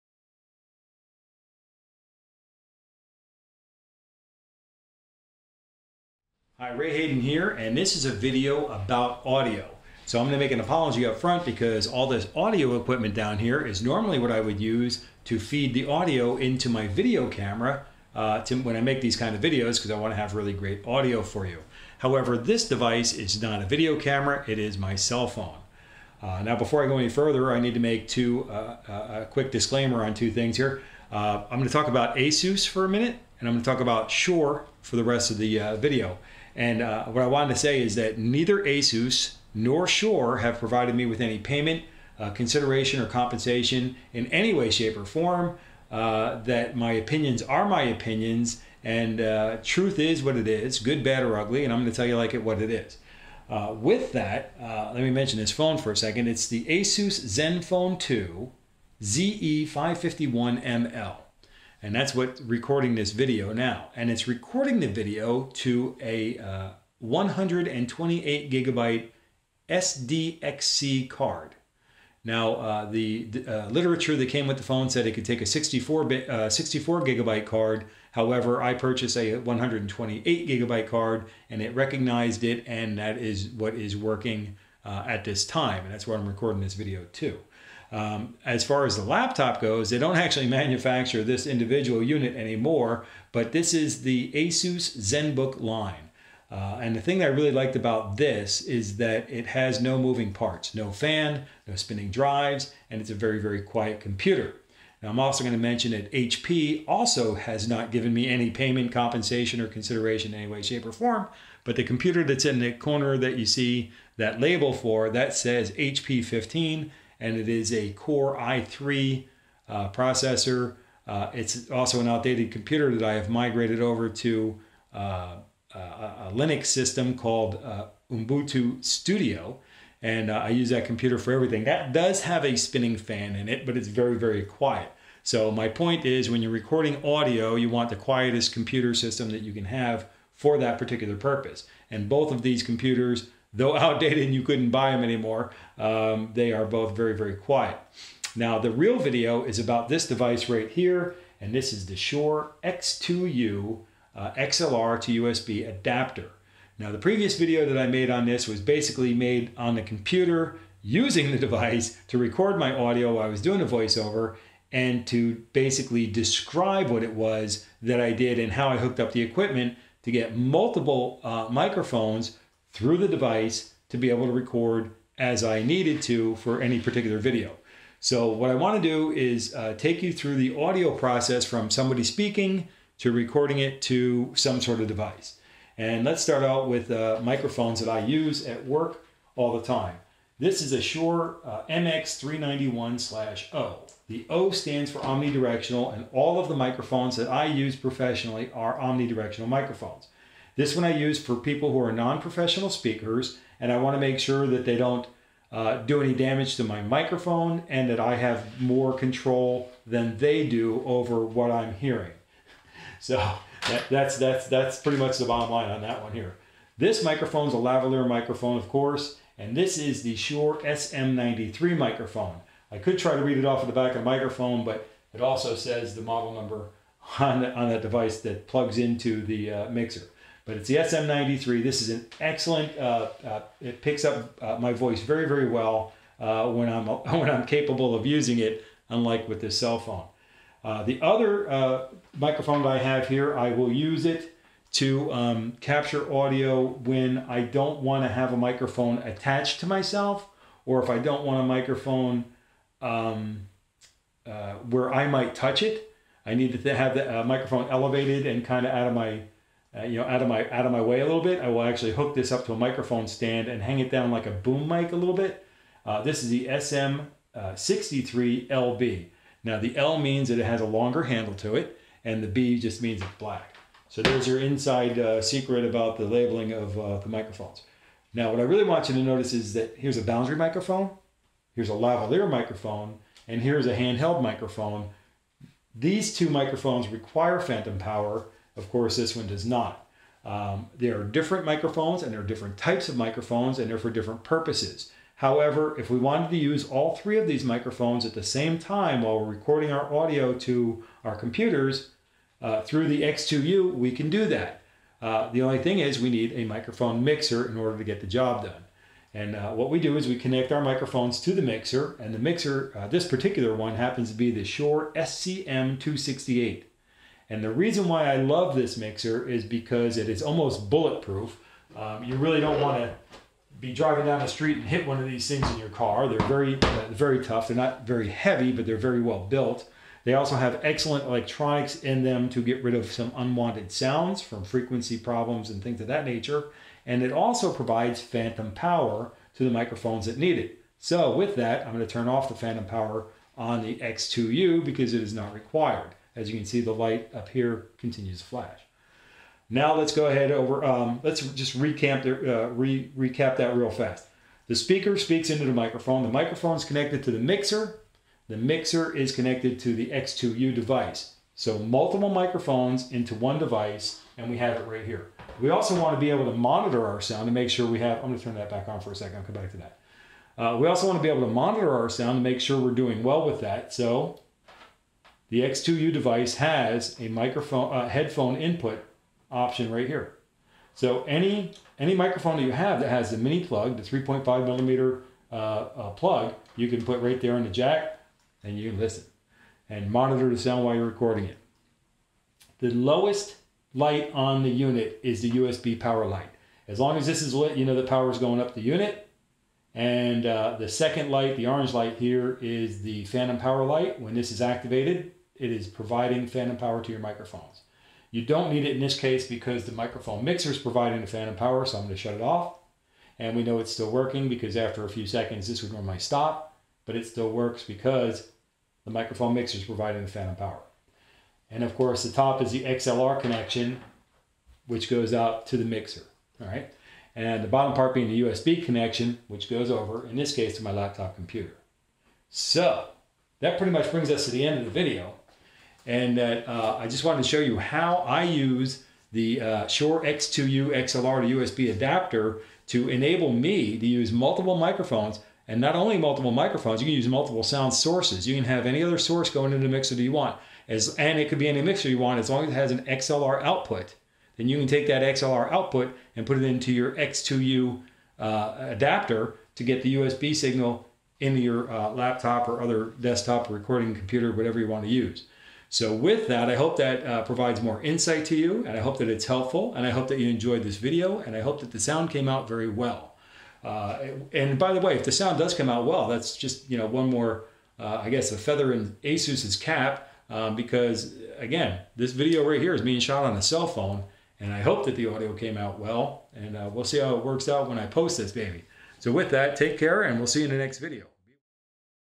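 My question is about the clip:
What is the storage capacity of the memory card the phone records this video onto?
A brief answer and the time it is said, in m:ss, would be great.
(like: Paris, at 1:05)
128 gigabytes, at 1:06.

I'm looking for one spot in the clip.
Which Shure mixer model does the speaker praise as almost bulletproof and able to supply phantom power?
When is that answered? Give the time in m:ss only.
5:14.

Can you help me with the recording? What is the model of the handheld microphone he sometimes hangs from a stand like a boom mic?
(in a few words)
SM63LB.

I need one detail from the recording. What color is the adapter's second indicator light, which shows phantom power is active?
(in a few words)
orange.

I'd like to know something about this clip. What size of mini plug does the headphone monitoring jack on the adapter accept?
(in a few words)
3.5 millimeter.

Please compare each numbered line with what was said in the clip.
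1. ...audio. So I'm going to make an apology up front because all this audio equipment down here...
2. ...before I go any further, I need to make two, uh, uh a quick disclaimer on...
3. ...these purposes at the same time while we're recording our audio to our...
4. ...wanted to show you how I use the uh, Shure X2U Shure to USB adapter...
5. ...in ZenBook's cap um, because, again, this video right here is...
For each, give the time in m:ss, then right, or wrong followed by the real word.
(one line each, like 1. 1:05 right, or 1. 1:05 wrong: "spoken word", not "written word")
1. 0:09 right
2. 0:26 right
3. 4:57 wrong: "microphones", not "purposes"
4. 7:17 wrong: "XLR", not "Shure"
5. 7:58 wrong: "Asus", not "ZenBook".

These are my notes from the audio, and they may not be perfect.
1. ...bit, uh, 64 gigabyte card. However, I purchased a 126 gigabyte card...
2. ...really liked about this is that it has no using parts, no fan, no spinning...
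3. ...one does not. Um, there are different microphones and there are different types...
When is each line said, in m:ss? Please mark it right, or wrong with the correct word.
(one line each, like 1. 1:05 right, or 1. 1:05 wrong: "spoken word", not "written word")
1. 1:16 wrong: "128", not "126"
2. 1:37 wrong: "moving", not "using"
3. 4:49 right.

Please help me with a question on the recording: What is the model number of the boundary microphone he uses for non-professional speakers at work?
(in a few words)
MX391-O.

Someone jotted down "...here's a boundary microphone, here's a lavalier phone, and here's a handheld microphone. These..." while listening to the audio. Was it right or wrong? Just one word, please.
wrong.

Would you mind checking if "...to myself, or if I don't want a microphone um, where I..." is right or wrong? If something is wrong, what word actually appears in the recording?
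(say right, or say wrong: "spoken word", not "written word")
right.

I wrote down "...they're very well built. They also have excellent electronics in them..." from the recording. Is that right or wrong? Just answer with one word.
right.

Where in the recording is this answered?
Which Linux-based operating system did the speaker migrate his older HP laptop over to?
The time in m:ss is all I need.
2:08.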